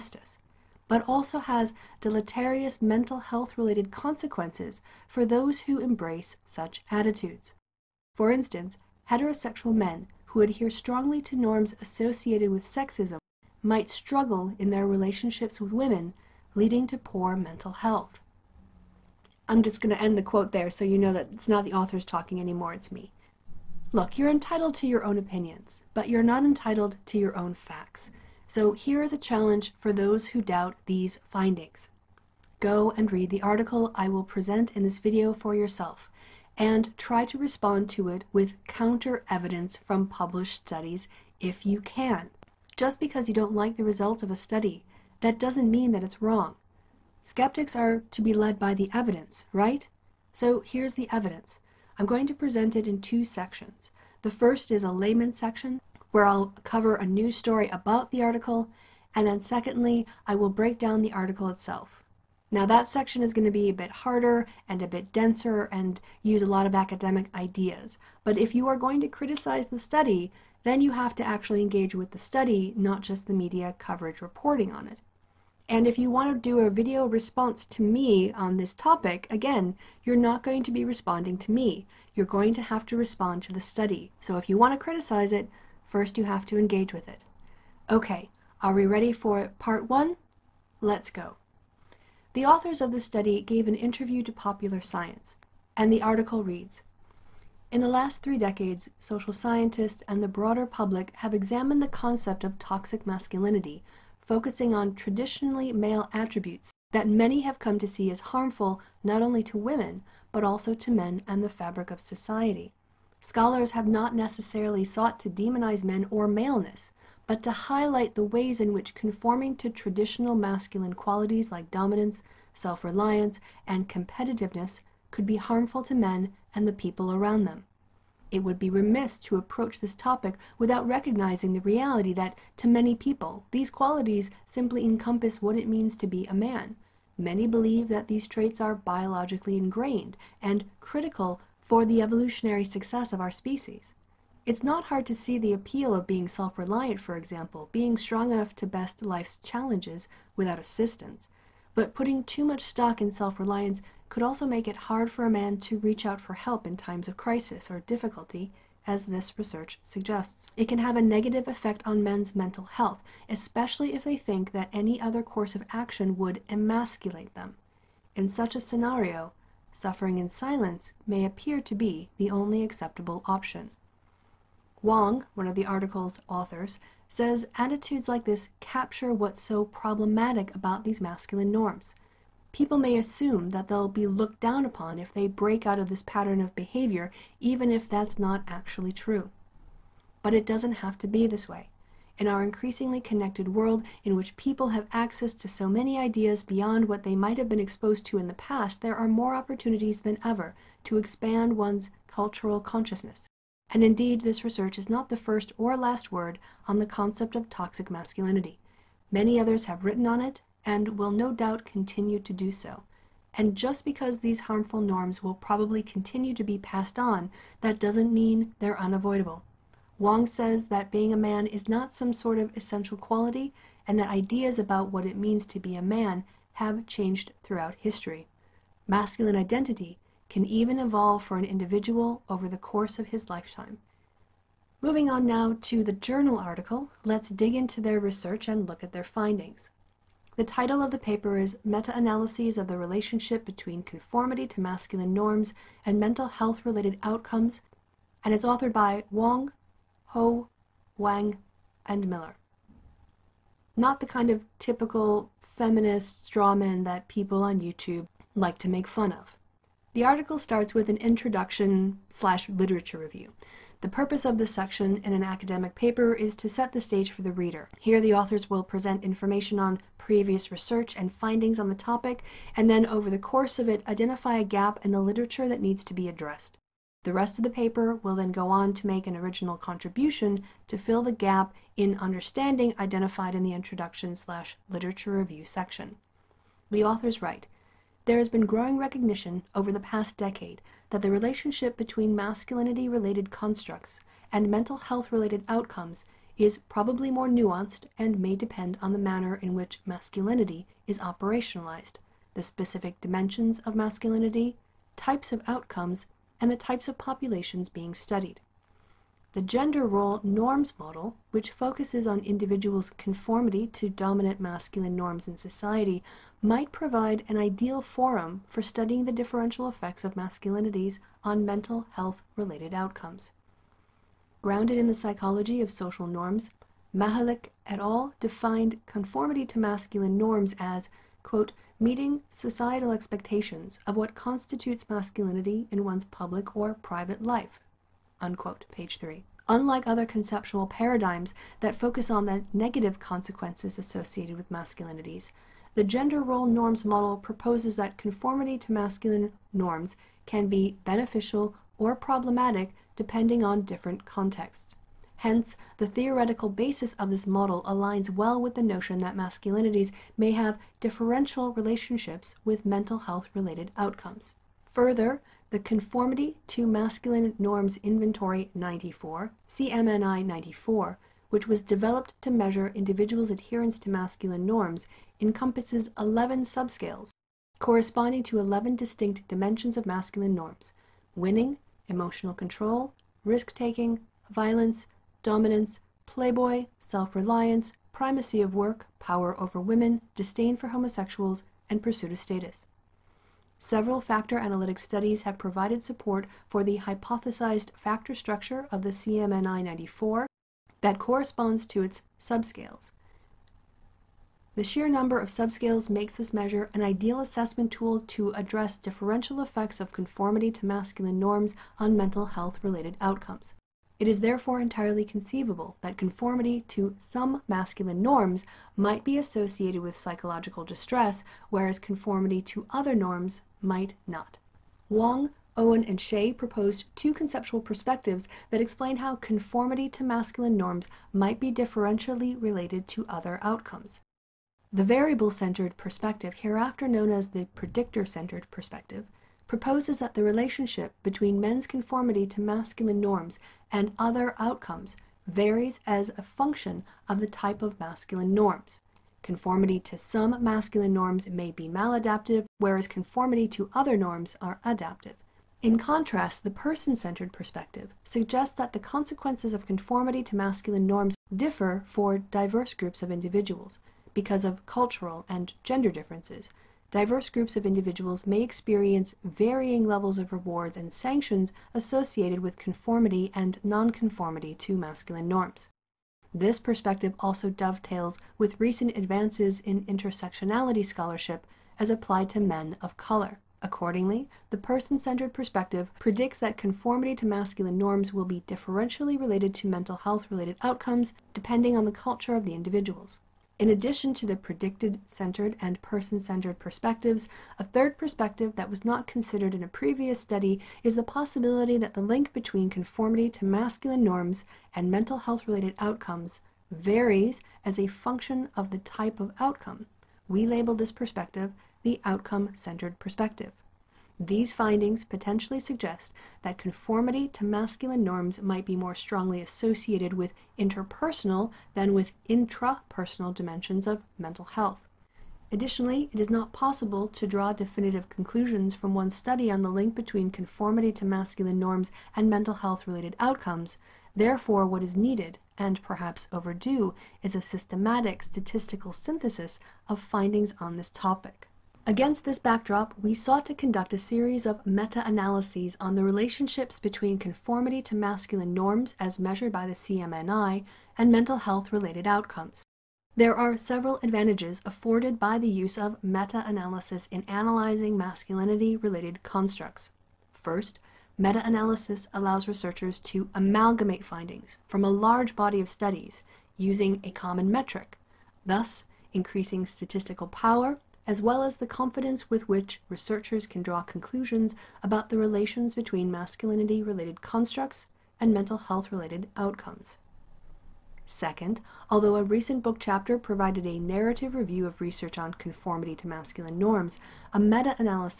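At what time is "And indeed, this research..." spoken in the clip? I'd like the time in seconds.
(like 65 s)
203 s.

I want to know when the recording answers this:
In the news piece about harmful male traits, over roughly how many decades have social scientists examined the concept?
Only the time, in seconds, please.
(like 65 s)
98 s.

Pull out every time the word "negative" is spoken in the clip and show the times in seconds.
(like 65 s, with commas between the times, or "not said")
161 s, 342 s.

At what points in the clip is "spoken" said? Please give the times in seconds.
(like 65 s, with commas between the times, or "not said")
not said.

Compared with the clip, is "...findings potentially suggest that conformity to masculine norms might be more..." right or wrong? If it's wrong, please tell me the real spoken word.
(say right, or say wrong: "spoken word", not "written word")
right.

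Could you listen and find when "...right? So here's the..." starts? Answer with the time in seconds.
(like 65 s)
49 s.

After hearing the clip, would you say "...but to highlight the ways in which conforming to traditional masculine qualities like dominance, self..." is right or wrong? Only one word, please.
right.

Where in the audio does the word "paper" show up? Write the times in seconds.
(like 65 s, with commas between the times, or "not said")
240 s, 265 s, 277 s.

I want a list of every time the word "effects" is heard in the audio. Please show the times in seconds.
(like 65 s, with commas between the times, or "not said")
161 s, 319 s, 409 s.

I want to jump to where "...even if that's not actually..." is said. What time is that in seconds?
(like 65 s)
187 s.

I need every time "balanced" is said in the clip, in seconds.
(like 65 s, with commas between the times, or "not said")
not said.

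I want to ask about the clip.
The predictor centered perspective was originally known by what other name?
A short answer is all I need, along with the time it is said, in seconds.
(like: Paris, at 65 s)
variable centered perspective, at 434 s.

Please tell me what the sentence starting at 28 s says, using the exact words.
So here is a challenge for those who doubt these findings.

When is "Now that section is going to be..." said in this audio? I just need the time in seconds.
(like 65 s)
62 s.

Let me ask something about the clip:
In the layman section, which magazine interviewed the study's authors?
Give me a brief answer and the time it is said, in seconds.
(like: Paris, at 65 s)
Popular Science, at 94 s.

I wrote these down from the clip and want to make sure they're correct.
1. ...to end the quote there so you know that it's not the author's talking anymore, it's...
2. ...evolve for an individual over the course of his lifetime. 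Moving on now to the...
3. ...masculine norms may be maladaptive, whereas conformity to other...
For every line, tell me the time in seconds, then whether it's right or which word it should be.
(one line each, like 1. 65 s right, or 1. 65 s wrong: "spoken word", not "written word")
1. 19 s right
2. 230 s right
3. 450 s right.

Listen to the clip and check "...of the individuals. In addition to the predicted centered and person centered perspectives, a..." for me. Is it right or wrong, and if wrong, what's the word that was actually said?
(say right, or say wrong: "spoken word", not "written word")
right.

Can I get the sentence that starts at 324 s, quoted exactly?
Grounded in the psychology of social norms, Mahalik et al.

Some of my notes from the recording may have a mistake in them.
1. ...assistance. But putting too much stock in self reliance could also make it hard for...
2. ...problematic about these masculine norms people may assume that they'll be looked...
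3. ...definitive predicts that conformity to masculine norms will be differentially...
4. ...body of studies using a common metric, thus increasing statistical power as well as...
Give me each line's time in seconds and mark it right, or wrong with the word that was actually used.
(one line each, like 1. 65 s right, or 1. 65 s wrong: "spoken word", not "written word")
1. 150 s right
2. 179 s right
3. 485 s wrong: "perspective", not "definitive"
4. 565 s right.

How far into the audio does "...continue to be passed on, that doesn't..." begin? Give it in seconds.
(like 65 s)
215 s.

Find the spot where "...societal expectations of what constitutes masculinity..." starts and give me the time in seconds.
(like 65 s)
332 s.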